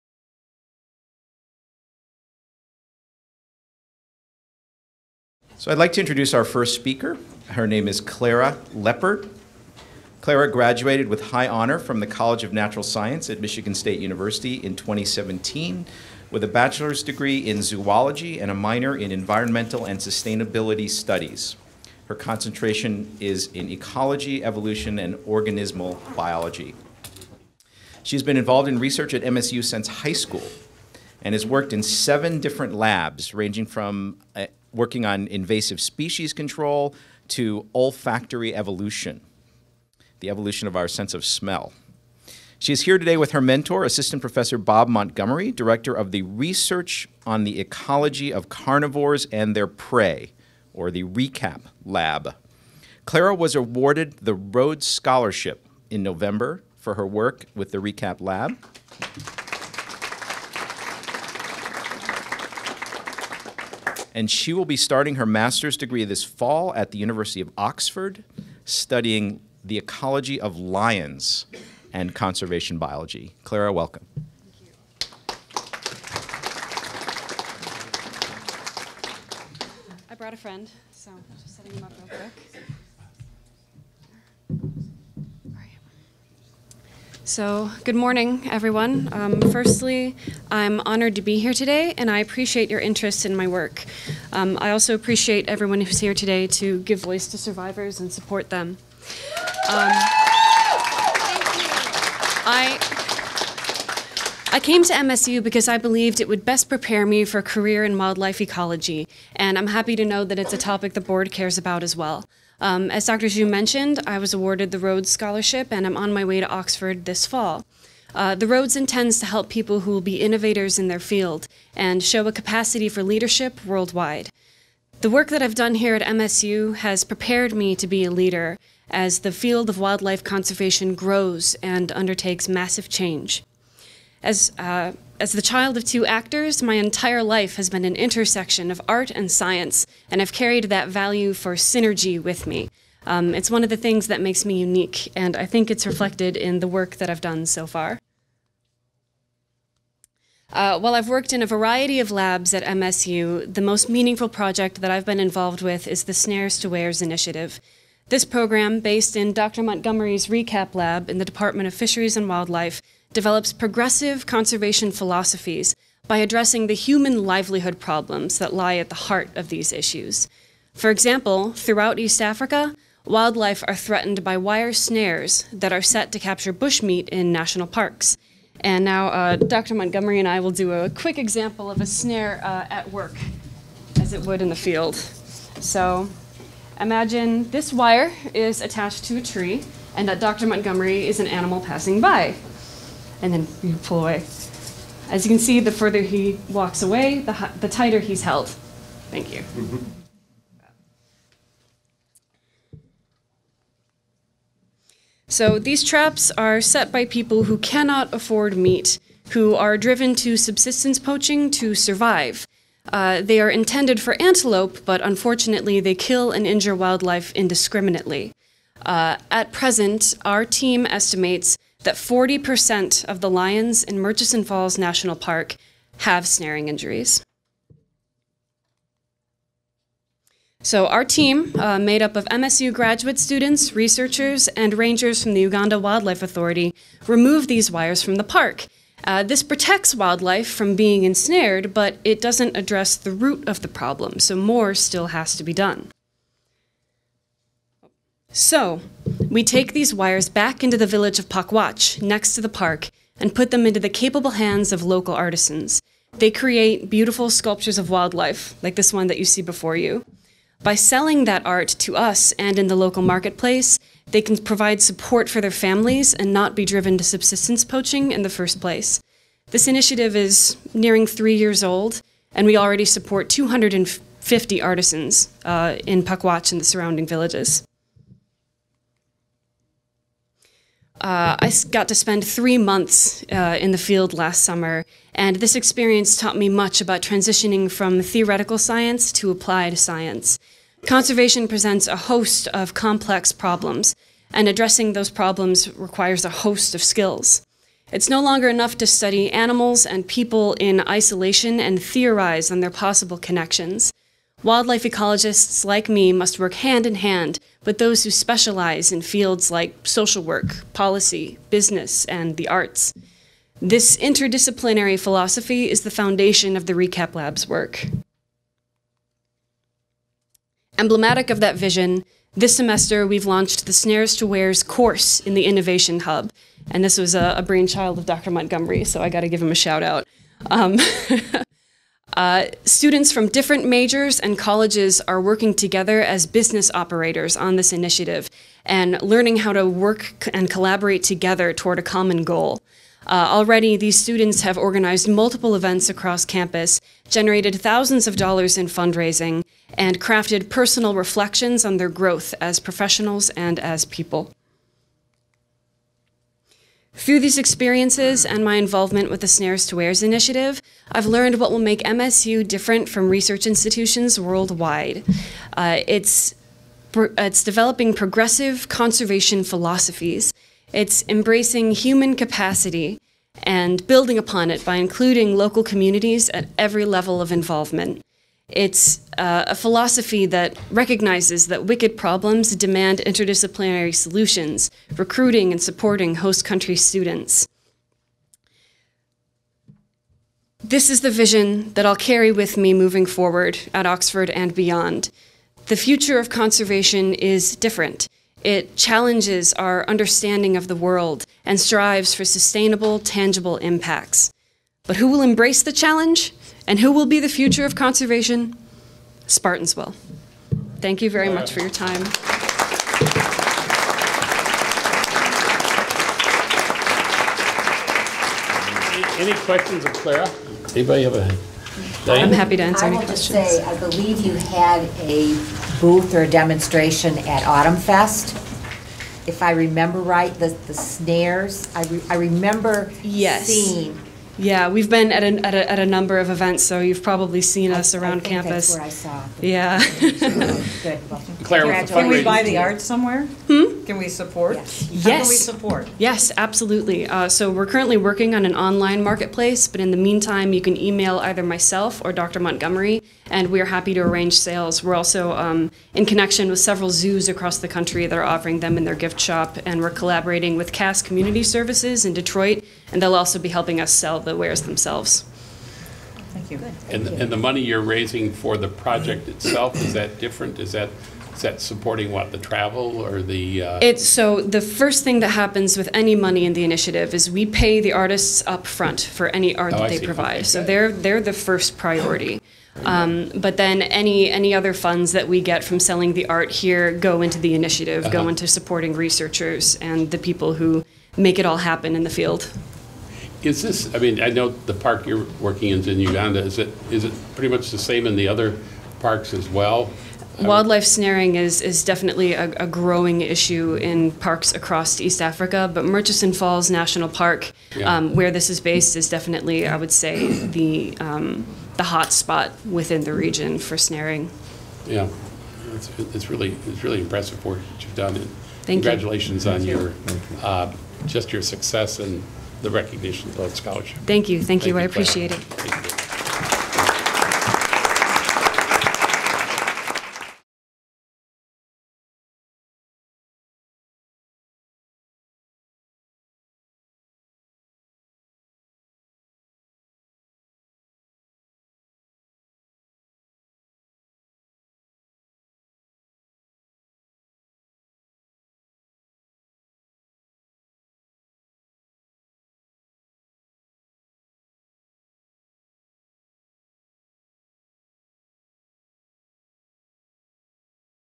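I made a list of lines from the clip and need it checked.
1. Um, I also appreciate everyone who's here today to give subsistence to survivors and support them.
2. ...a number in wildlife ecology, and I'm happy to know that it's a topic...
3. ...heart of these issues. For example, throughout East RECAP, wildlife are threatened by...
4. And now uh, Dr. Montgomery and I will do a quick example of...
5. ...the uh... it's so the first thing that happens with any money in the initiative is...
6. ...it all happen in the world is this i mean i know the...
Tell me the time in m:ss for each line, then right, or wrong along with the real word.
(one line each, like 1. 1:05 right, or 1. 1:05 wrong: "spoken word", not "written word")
1. 1:34 wrong: "voice", not "subsistence"
2. 1:47 wrong: "career", not "number"
3. 2:48 wrong: "Africa", not "RECAP"
4. 2:58 right
5. 7:53 right
6. 8:11 wrong: "field", not "world".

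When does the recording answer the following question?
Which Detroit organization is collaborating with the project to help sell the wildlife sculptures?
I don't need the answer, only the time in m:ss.
7:40.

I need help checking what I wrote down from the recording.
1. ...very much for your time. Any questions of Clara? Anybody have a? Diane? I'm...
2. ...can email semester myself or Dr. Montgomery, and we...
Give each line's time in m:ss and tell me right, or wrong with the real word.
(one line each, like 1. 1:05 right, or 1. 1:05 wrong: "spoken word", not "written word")
1. 6:51 right
2. 7:30 wrong: "either", not "semester".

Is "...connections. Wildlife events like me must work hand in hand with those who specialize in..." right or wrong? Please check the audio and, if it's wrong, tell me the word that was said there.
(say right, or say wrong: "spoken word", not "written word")
wrong: "ecologists", not "events".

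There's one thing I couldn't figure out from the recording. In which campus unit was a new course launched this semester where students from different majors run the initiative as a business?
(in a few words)
Innovation Hub.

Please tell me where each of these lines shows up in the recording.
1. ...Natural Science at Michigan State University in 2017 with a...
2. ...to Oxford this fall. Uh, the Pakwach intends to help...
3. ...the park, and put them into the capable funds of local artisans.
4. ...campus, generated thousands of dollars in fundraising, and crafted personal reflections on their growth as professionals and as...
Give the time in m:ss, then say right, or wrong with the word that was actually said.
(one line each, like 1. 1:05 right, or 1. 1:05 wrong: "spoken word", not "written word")
1. 0:12 right
2. 1:56 wrong: "Rhodes", not "Pakwach"
3. 4:12 wrong: "hands", not "funds"
4. 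5:46 right.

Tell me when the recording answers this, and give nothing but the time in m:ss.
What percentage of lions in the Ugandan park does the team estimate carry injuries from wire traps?
3:41.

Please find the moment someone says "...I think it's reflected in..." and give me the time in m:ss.
2:25.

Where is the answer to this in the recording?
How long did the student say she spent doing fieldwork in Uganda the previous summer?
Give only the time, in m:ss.
4:42.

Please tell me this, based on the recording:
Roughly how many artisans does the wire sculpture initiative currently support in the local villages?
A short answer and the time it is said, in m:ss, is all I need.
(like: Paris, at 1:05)
250, at 4:33.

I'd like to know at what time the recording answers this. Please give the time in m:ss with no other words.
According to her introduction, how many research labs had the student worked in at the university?
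0:31.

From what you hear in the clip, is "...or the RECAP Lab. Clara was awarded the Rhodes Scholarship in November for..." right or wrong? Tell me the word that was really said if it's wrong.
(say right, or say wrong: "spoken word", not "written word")
right.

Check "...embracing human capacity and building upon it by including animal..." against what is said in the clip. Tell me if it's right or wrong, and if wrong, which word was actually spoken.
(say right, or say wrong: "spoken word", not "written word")
wrong: "local", not "animal".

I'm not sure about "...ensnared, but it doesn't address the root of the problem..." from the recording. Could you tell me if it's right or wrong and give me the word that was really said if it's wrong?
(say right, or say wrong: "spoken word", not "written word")
right.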